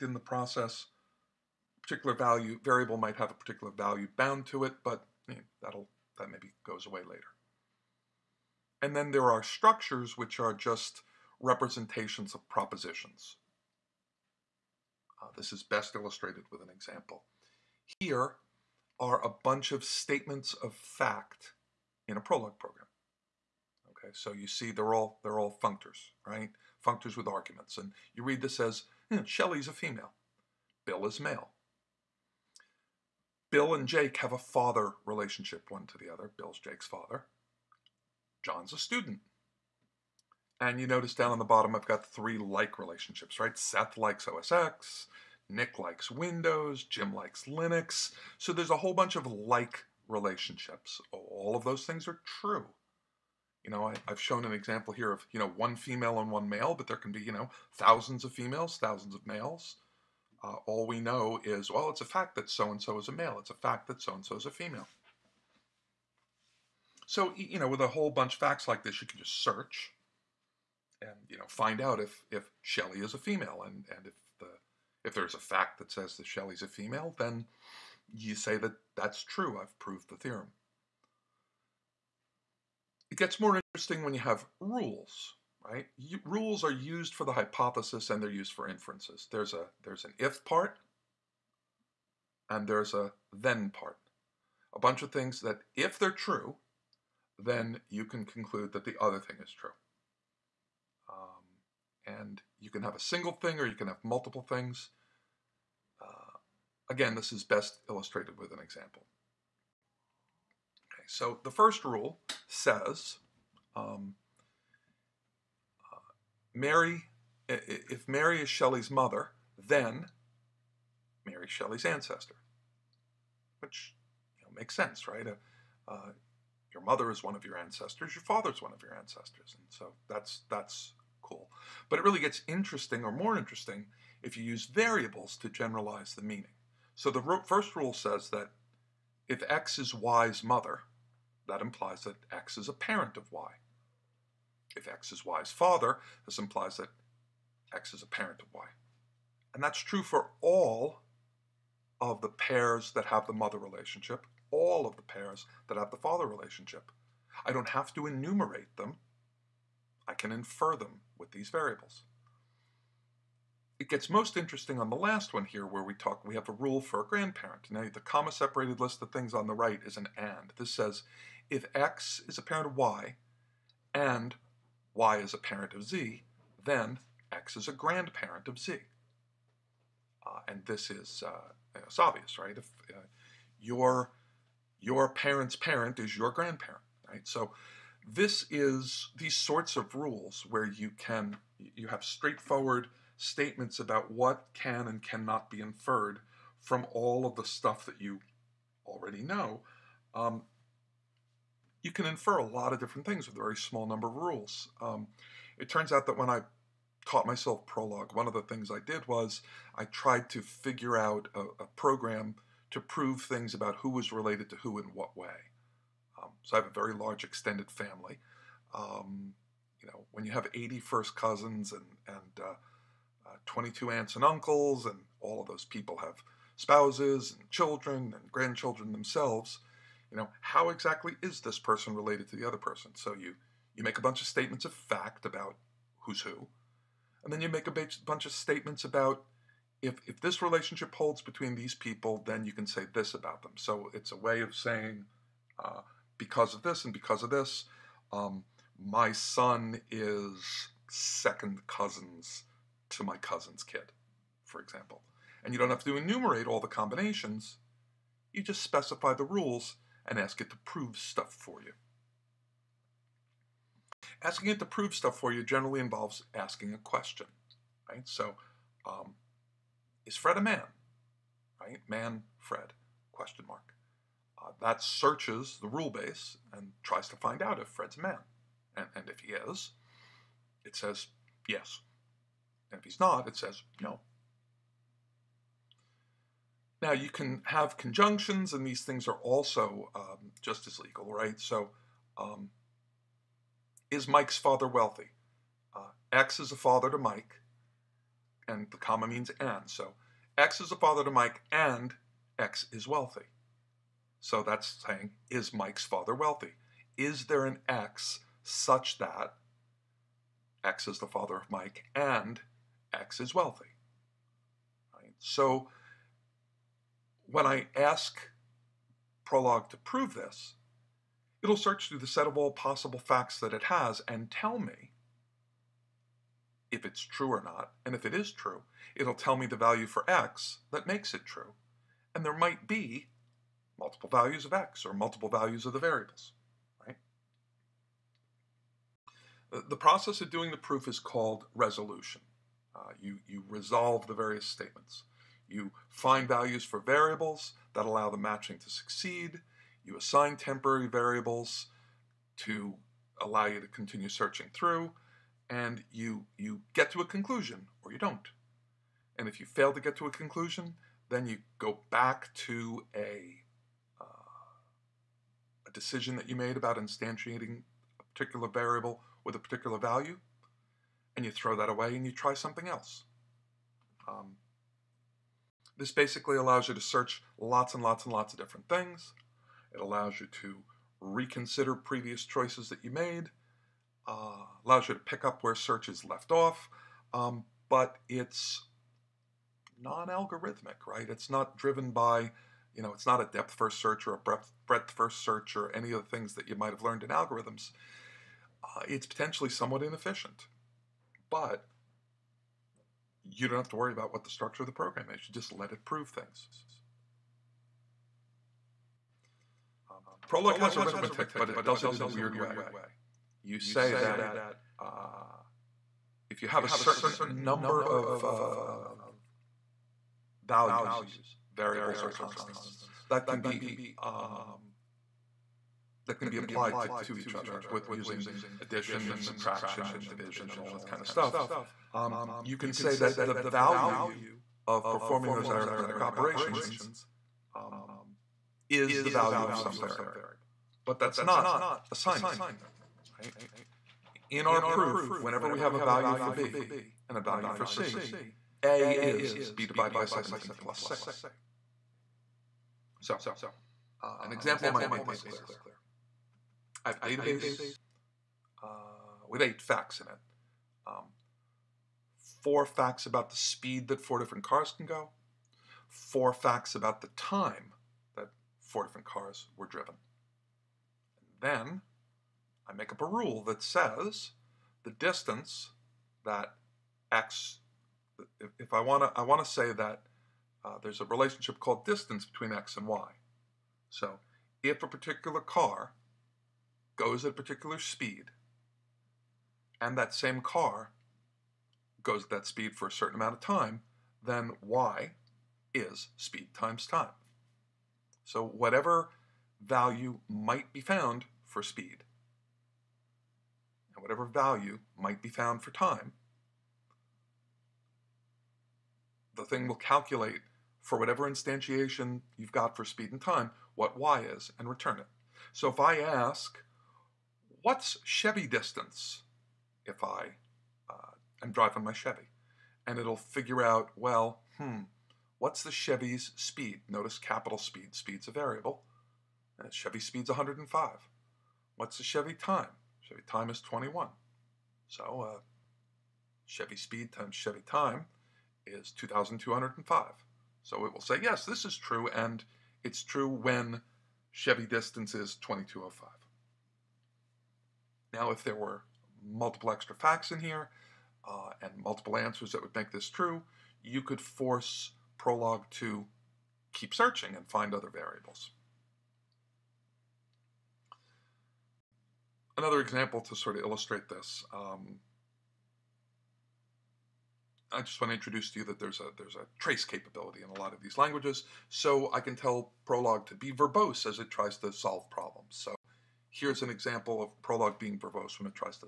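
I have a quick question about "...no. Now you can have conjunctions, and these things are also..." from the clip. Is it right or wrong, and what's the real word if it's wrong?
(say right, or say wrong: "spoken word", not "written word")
right.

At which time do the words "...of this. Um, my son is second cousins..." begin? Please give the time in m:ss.
4:07.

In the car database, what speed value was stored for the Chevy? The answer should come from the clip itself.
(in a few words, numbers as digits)
105.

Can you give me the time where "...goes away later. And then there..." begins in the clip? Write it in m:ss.
0:06.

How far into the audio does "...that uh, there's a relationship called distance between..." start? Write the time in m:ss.
7:59.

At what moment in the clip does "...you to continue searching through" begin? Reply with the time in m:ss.
5:53.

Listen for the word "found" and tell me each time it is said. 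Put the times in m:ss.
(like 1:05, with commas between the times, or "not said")
8:20, 8:25.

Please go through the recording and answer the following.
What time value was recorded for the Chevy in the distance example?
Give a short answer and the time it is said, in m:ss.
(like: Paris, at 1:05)
21, at 8:53.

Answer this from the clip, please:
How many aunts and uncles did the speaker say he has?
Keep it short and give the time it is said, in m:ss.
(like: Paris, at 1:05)
22, at 3:43.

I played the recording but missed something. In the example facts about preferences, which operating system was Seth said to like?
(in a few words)
OSX.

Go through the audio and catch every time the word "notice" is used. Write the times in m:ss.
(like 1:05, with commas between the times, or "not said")
0:40, 8:46.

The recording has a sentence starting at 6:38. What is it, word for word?
Uh, it's potentially somewhat inefficient, but you don't have to worry about what the structure of the program is.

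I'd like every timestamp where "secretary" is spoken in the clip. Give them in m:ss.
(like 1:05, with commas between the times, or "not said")
not said.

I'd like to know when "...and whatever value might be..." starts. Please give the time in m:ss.
8:23.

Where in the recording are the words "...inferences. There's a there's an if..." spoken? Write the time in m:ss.
1:28.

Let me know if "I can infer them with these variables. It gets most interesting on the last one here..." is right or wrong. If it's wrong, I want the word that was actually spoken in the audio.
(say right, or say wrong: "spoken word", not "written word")
right.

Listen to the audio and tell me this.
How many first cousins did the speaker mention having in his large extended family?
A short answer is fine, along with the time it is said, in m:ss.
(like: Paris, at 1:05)
80, at 3:40.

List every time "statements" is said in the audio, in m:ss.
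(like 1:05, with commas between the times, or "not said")
0:19, 3:13, 3:54, 3:58, 5:44.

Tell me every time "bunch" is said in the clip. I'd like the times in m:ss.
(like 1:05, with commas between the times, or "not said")
0:19, 0:48, 1:08, 1:34, 3:54, 3:58.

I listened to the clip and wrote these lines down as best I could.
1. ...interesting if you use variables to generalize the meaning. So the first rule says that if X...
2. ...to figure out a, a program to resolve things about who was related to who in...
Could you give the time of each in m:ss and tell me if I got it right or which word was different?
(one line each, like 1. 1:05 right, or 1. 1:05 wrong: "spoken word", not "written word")
1. 2:13 right
2. 3:30 wrong: "prove", not "resolve".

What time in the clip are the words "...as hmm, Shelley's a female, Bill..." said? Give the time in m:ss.
0:28.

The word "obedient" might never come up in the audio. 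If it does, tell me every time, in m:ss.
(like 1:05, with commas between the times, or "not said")
not said.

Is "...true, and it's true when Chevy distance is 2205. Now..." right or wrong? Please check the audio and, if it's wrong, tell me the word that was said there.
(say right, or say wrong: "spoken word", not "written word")
right.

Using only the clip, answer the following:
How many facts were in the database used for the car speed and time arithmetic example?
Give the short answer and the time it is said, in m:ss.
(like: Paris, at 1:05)
8, at 7:39.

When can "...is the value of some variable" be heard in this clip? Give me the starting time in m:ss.
7:18.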